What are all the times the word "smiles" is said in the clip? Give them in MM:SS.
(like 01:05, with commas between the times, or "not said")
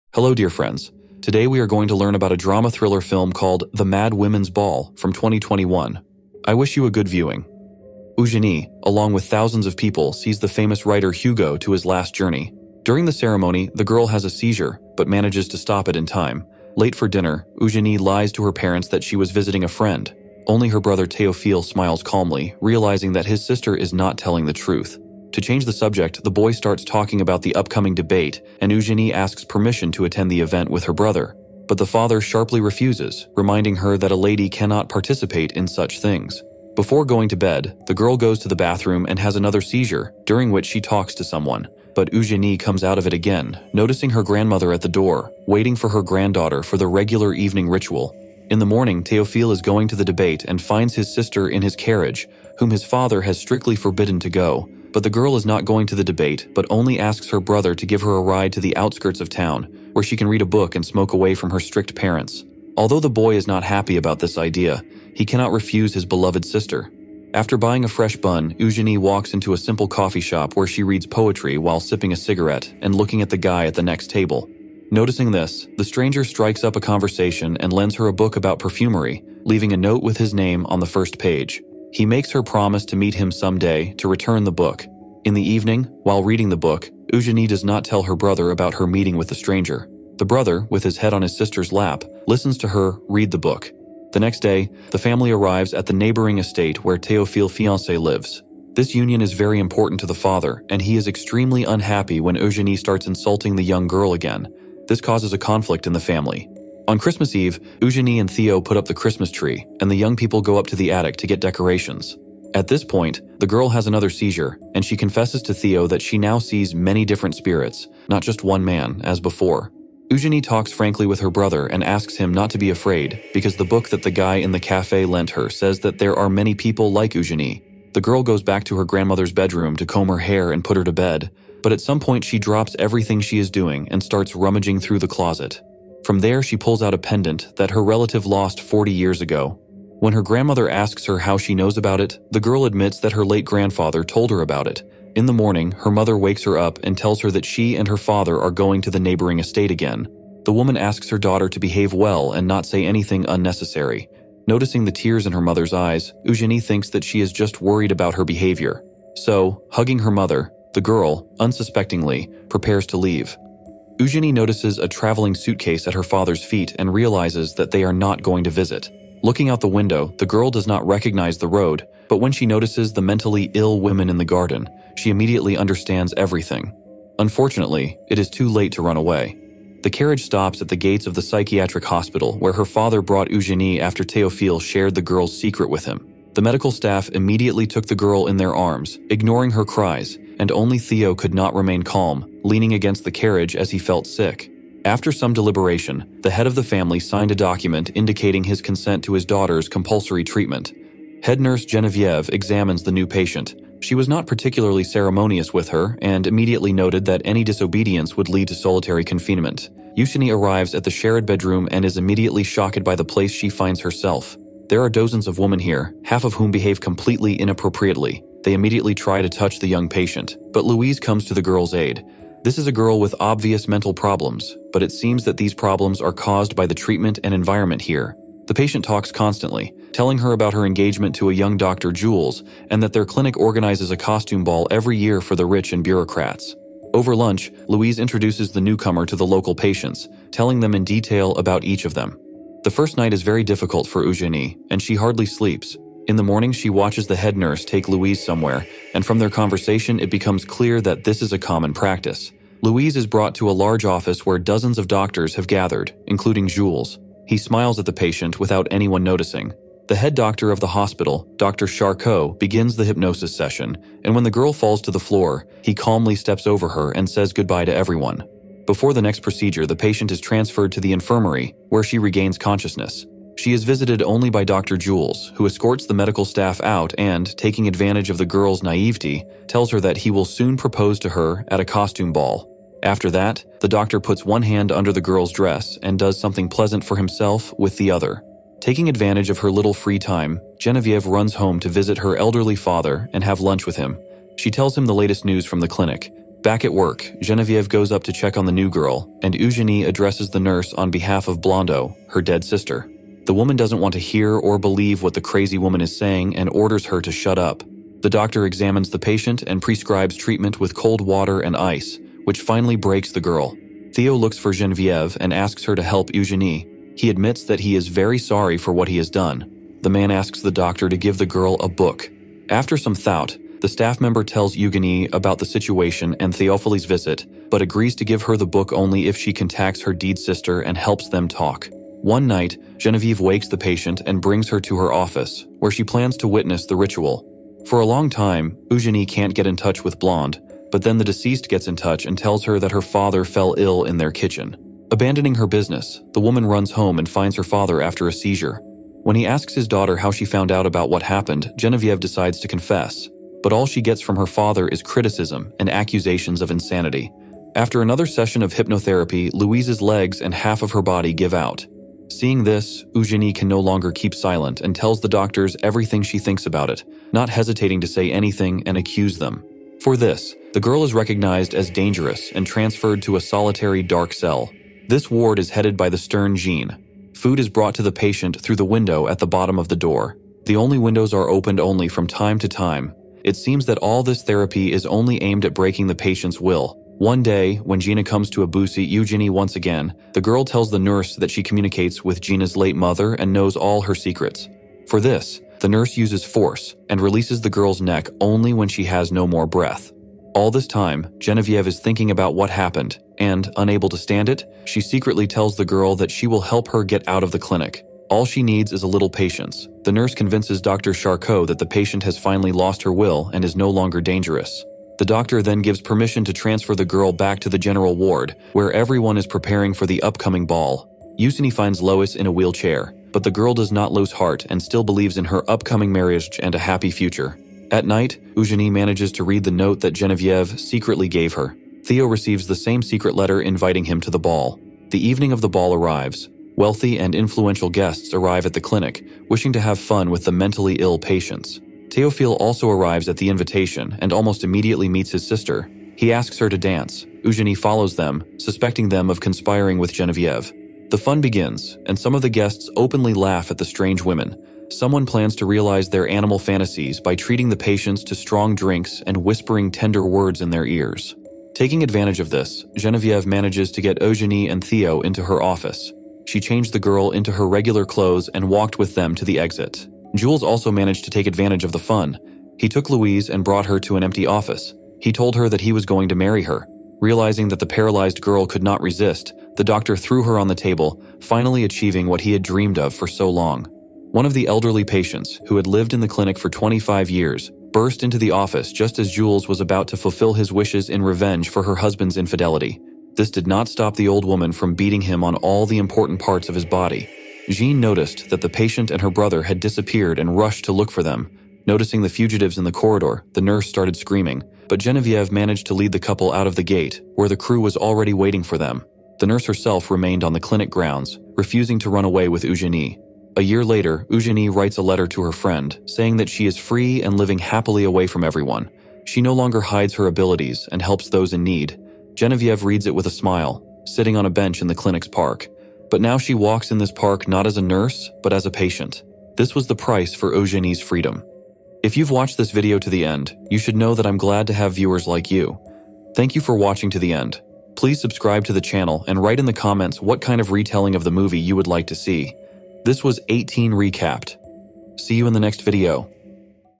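00:21, 04:17, 08:43.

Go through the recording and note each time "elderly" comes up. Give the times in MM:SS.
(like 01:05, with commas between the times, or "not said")
04:52, 08:04.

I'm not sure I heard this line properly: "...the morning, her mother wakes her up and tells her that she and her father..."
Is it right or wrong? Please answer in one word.
right.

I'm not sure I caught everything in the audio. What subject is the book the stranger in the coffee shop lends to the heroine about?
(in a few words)
Perfumery.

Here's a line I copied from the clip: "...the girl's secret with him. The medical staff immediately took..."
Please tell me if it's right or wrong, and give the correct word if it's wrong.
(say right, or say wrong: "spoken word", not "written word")
right.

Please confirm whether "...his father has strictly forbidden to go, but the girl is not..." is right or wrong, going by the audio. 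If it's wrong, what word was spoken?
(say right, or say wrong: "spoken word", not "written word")
right.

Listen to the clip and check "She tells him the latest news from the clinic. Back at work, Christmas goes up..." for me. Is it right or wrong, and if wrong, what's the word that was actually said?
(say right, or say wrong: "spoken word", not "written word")
wrong: "Genevieve", not "Christmas".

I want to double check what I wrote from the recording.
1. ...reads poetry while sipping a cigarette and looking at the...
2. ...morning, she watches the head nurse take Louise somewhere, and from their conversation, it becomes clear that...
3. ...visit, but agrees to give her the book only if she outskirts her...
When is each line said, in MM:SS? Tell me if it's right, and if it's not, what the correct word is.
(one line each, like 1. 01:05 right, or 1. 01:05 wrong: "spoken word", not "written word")
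1. 01:10 right
2. 04:06 right
3. 05:26 wrong: "contacts", not "outskirts".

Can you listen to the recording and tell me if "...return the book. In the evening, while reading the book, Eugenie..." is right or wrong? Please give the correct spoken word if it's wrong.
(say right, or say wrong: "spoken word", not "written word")
right.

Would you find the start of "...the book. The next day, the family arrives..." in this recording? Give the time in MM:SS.
01:33.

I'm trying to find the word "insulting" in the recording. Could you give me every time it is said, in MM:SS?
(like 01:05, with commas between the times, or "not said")
01:43.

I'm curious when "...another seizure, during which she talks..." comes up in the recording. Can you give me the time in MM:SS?
00:39.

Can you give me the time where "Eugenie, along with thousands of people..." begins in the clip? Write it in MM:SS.
00:08.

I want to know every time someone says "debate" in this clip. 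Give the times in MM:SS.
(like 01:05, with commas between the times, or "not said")
00:27, 00:50, 00:56.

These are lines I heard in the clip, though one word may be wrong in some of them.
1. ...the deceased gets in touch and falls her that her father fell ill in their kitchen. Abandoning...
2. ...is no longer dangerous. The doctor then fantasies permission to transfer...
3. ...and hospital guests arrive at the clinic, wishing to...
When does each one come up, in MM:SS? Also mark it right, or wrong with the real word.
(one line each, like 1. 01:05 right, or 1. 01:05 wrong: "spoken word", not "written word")
1. 05:40 wrong: "tells", not "falls"
2. 06:53 wrong: "gives", not "fantasies"
3. 07:16 wrong: "influential", not "hospital".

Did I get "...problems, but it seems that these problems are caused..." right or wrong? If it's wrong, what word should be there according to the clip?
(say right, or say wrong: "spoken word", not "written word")
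right.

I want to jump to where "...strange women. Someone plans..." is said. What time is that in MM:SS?
07:33.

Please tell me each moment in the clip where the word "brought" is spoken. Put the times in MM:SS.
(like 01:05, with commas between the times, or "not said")
03:03, 04:13, 06:17, 07:53.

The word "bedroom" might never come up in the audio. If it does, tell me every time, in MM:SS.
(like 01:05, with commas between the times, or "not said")
02:09, 03:31.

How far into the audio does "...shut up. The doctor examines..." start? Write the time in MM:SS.
05:07.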